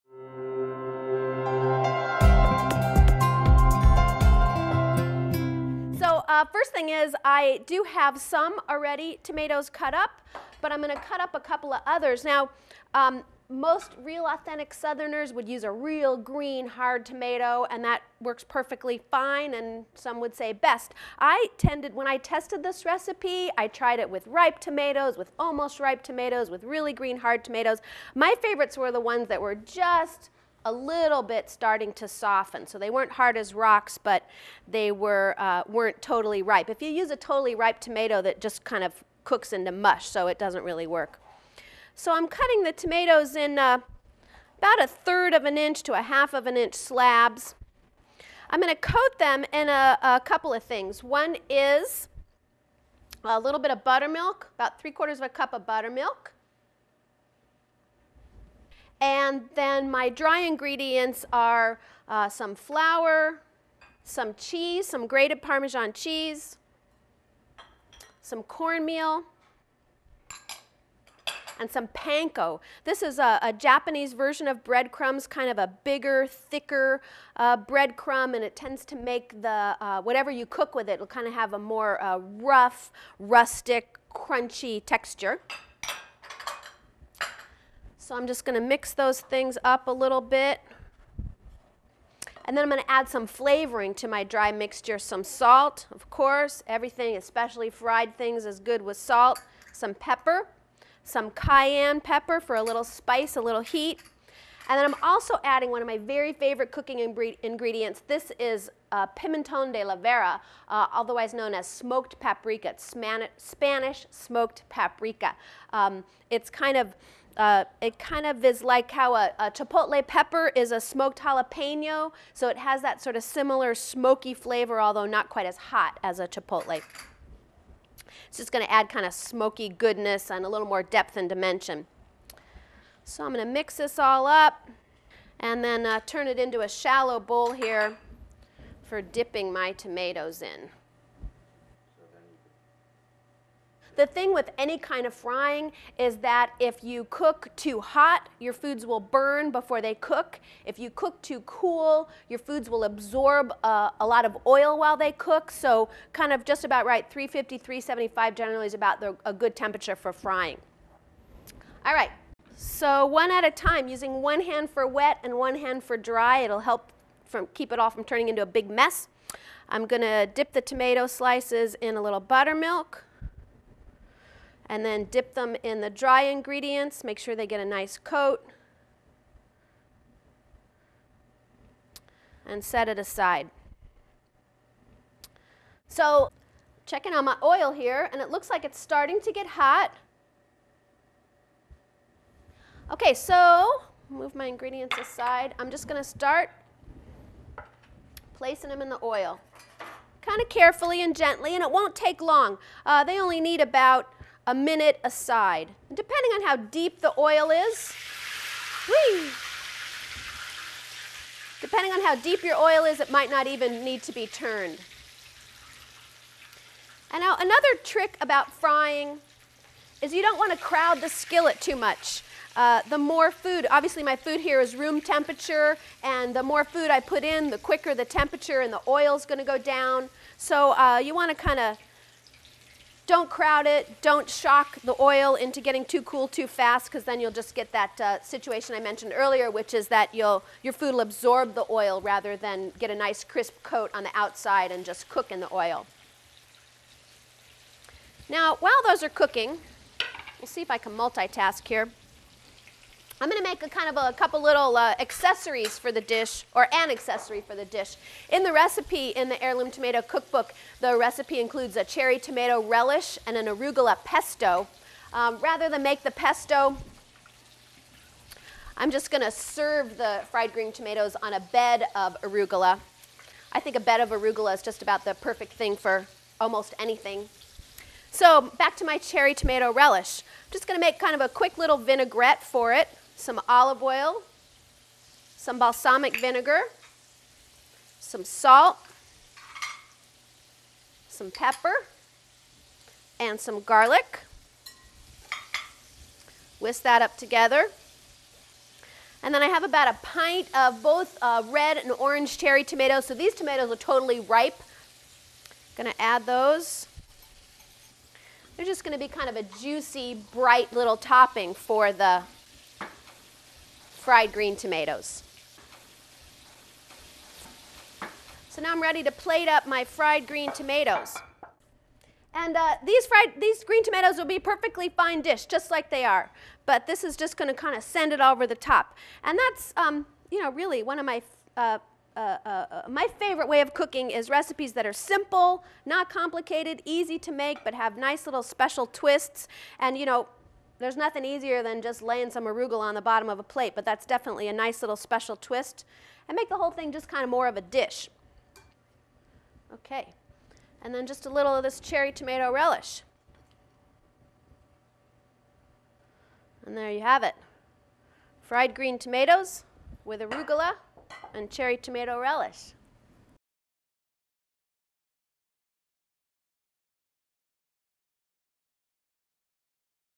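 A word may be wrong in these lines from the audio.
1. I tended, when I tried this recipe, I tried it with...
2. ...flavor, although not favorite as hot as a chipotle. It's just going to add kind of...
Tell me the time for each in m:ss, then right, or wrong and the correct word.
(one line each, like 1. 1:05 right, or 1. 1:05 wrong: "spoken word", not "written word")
1. 0:21 wrong: "tested", not "tried"
2. 2:04 wrong: "quite", not "favorite".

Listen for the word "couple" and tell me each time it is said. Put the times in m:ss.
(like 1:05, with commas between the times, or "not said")
0:11, 0:50, 4:14.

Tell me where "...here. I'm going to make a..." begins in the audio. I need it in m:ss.
4:11.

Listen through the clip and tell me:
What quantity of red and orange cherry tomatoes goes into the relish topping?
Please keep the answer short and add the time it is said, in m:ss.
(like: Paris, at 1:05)
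About a pint, at 4:59.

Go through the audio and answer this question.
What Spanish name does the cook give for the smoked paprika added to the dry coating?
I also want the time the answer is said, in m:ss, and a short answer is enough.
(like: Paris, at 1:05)
pimenton de la vera, at 1:49.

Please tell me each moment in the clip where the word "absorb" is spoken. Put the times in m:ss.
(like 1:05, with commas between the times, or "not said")
2:32, 4:01.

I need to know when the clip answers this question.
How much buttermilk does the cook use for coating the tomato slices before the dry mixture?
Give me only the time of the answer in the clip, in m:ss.
0:54.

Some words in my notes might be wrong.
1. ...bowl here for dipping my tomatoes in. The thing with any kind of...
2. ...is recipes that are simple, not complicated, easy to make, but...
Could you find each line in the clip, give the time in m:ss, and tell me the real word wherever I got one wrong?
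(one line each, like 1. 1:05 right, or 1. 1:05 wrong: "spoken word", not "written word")
1. 2:17 right
2. 5:34 right.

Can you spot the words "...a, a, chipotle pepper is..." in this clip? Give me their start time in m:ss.
1:59.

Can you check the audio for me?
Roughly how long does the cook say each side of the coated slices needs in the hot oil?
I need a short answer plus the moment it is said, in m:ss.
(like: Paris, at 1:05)
About a minute, at 3:23.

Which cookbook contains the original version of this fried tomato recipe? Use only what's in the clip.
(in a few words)
Heirloom Tomato Cookbook.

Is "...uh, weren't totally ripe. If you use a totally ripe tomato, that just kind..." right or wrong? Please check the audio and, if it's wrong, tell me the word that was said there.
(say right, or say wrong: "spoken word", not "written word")
right.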